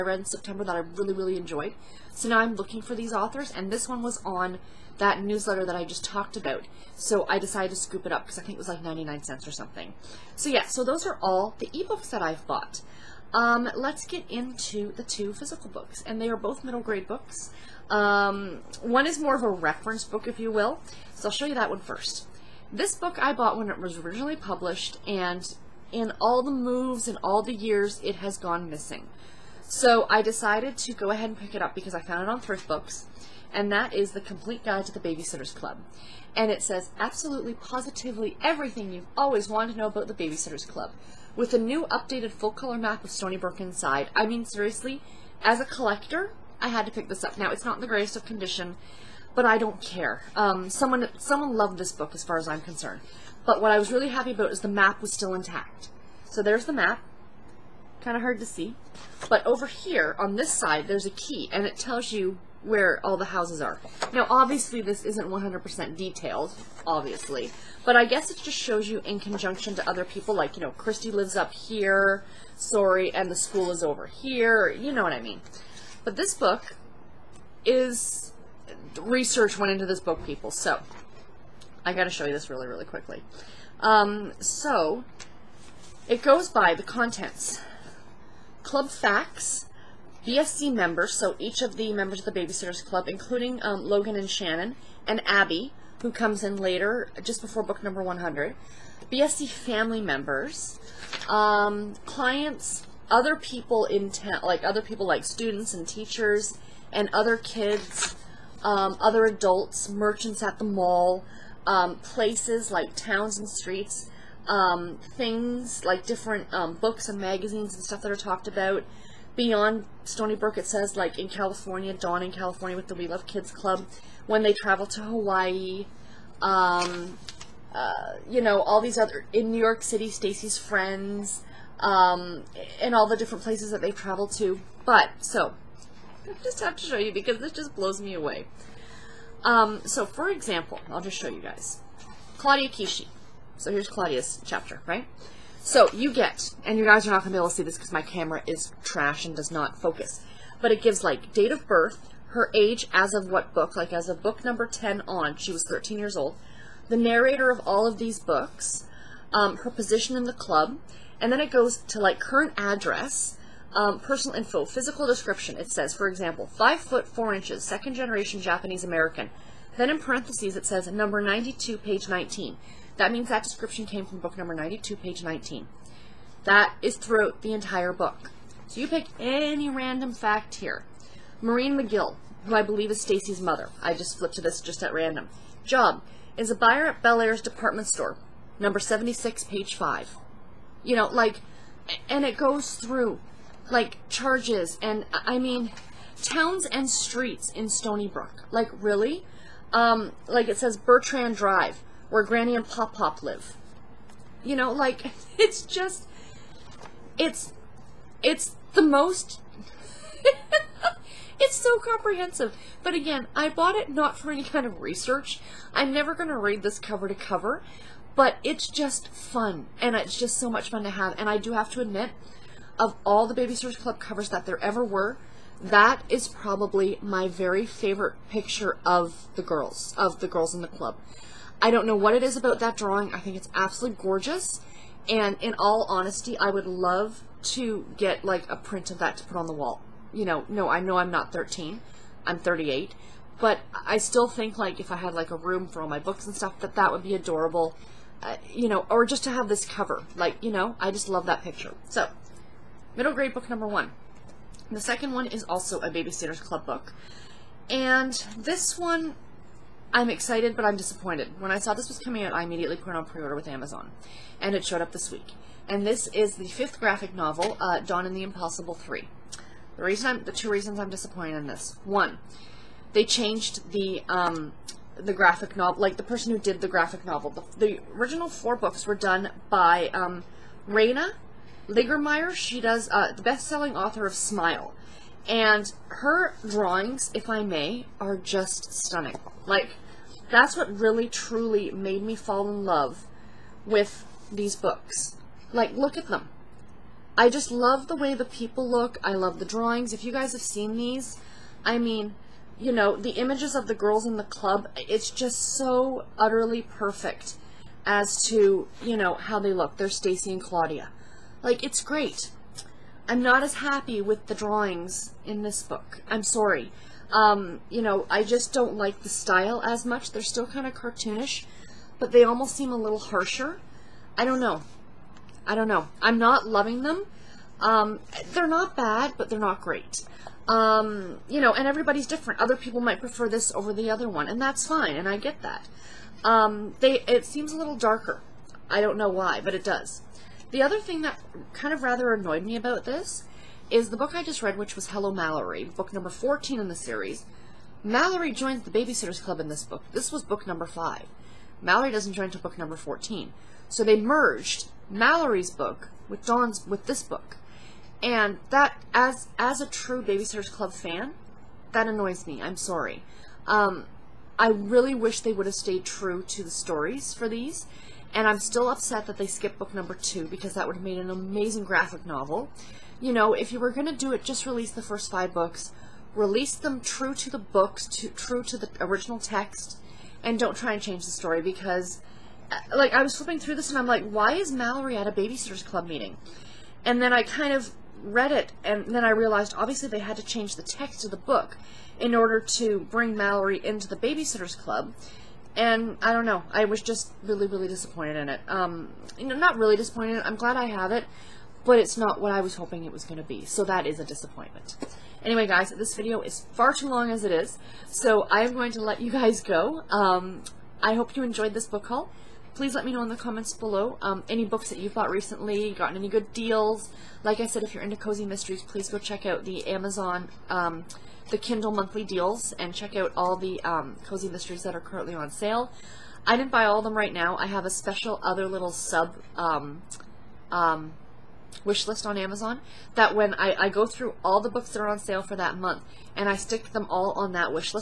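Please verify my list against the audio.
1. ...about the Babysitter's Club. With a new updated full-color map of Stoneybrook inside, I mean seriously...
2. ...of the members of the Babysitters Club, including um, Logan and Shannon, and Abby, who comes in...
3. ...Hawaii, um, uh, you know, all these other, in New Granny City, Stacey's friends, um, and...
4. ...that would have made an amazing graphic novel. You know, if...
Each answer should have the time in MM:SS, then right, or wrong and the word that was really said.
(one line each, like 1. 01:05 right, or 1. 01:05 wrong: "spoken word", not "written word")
1. 00:39 right
2. 01:31 right
3. 02:05 wrong: "York", not "Granny"
4. 06:10 right.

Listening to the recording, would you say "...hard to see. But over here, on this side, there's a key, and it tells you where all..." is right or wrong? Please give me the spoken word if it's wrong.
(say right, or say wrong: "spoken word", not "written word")
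right.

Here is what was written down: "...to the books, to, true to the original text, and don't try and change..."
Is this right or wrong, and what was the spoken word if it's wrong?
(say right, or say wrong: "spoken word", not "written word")
right.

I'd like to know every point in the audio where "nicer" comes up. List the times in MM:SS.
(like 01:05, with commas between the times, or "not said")
not said.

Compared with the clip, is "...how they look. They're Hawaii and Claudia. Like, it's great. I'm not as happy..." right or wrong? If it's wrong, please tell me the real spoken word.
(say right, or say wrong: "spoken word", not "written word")
wrong: "Stacey", not "Hawaii".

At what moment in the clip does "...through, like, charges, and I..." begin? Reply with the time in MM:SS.
03:12.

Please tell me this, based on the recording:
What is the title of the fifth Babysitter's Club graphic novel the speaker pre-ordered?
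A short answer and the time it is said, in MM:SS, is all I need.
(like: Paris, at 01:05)
Dawn and the Impossible 3, at 04:27.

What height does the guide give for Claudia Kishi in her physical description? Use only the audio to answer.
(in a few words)
5 foot 4 inches.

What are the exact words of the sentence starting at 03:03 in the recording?
I just flipped to this just at random.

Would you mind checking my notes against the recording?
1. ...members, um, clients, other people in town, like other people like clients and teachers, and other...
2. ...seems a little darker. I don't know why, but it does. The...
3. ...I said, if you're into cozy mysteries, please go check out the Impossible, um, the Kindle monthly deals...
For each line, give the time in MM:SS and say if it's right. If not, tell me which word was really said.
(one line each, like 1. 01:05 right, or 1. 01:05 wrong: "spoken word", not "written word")
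1. 01:40 wrong: "students", not "clients"
2. 05:37 right
3. 06:57 wrong: "Amazon", not "Impossible".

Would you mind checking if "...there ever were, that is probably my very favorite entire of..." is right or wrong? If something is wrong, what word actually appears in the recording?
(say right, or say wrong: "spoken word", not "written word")
wrong: "picture", not "entire".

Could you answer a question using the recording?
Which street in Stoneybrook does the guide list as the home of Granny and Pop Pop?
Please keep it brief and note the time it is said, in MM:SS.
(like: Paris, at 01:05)
Bertrand Drive, at 03:20.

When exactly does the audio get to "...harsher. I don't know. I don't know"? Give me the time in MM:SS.
05:22.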